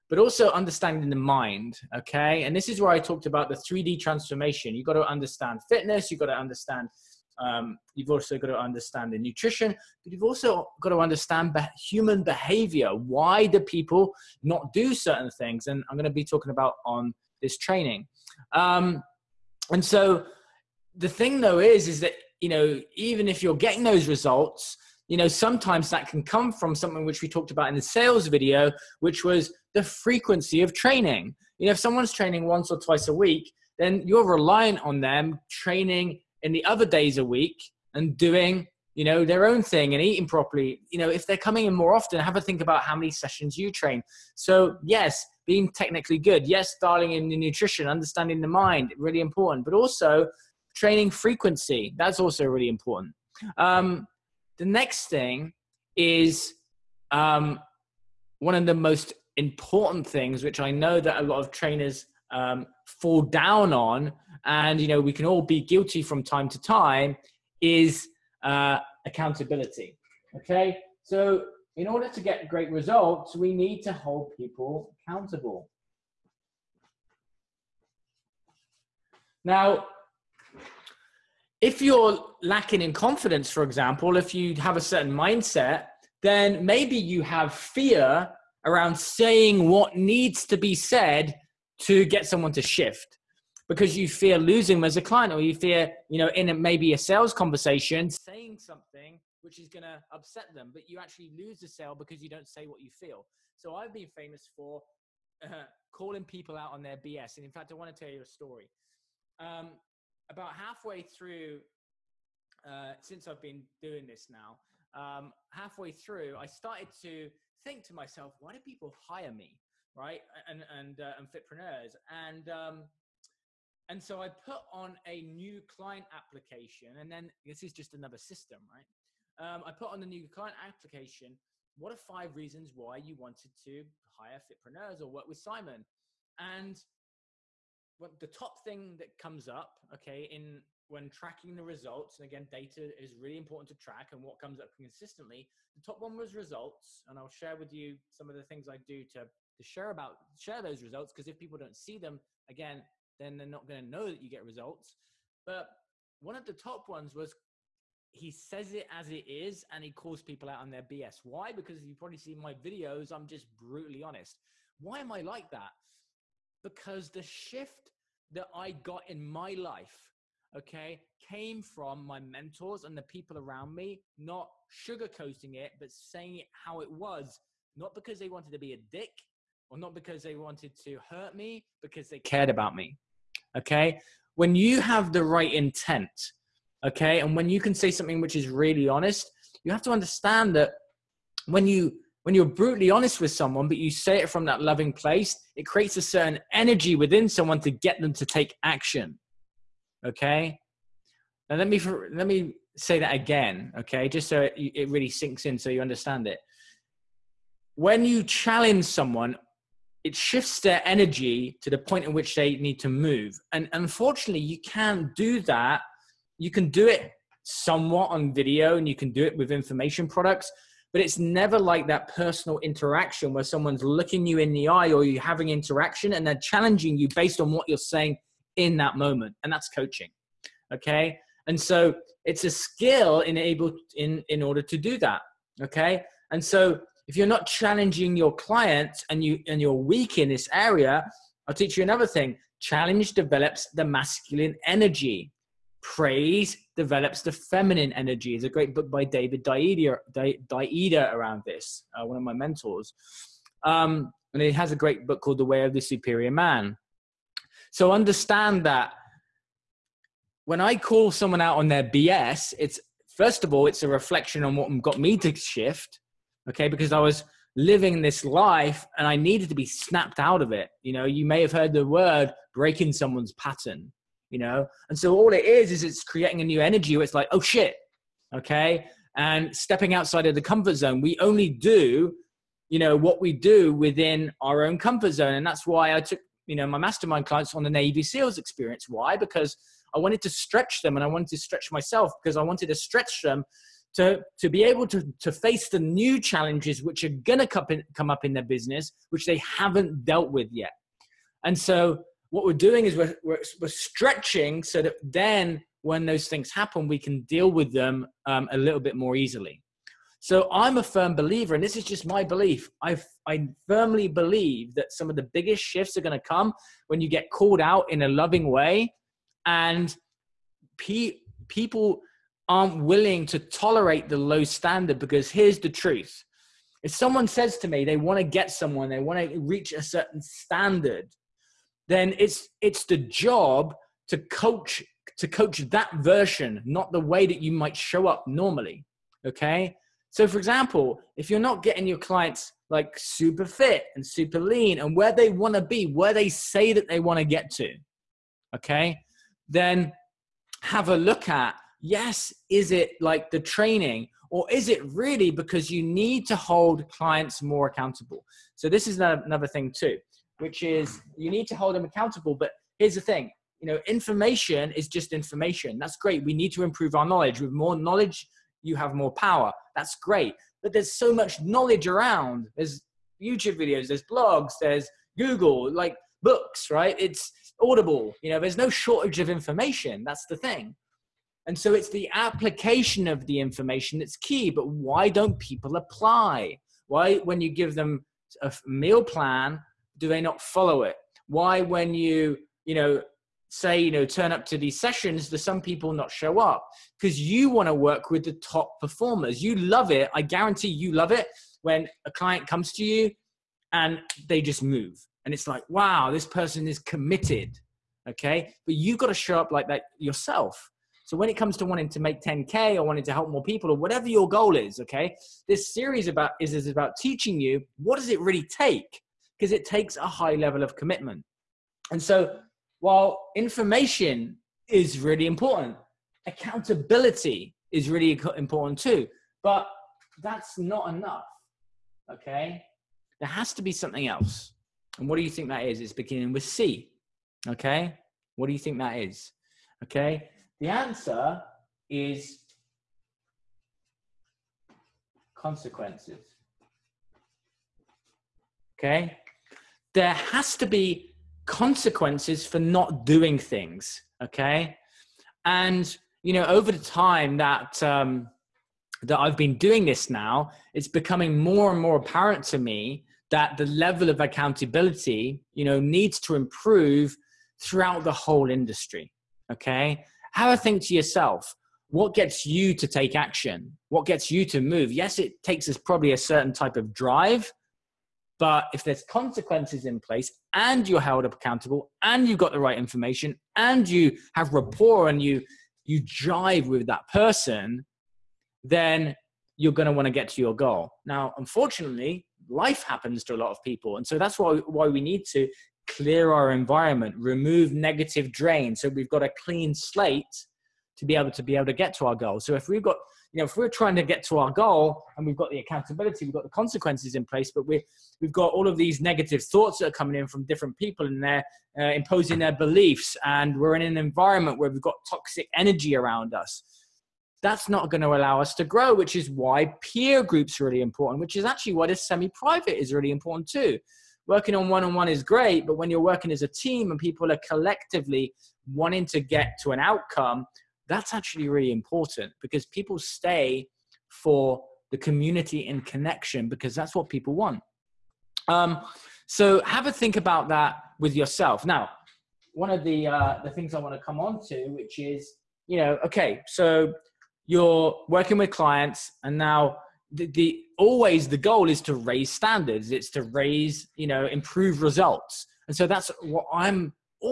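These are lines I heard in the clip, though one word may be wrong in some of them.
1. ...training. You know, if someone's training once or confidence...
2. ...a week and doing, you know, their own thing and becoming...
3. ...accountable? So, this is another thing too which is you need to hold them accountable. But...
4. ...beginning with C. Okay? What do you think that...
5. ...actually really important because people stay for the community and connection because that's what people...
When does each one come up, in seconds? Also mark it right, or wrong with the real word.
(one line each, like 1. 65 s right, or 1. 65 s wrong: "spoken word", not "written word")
1. 30 s wrong: "twice", not "confidence"
2. 37 s wrong: "eating", not "becoming"
3. 357 s right
4. 435 s right
5. 531 s right.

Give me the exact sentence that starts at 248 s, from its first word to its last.
There's a great book by David Deida, Deida around this, uh, one of my mentors.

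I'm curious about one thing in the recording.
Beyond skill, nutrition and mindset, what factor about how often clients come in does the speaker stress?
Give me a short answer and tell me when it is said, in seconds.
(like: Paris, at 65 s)
Training frequency, at 50 s.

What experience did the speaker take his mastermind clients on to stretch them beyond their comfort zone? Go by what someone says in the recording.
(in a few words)
Navy SEALs experience.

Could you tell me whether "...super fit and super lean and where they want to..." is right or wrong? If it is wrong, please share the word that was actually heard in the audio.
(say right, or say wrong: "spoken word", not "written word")
right.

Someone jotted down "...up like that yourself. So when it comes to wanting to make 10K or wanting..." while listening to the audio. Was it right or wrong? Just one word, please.
right.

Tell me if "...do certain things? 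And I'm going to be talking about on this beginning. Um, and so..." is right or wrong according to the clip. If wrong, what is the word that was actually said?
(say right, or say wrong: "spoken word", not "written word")
wrong: "training", not "beginning".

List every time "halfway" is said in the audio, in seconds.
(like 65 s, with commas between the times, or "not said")
110 s, 115 s.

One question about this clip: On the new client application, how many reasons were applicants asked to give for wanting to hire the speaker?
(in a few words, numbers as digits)
5.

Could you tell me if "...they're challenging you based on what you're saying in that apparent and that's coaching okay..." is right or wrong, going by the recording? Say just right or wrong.
wrong.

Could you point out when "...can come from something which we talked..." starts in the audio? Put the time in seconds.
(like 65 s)
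26 s.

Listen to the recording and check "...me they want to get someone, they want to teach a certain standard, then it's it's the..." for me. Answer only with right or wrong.
wrong.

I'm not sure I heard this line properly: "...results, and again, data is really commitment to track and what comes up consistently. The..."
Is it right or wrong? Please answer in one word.
wrong.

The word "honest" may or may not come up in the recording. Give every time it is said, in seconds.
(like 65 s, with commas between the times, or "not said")
164 s, 188 s, 192 s.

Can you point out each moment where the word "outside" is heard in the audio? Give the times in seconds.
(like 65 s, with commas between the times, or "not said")
279 s.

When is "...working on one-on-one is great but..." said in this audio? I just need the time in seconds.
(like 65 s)
524 s.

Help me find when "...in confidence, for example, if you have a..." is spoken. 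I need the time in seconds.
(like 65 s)
82 s.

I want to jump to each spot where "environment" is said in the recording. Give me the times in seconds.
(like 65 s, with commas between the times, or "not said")
496 s, 513 s.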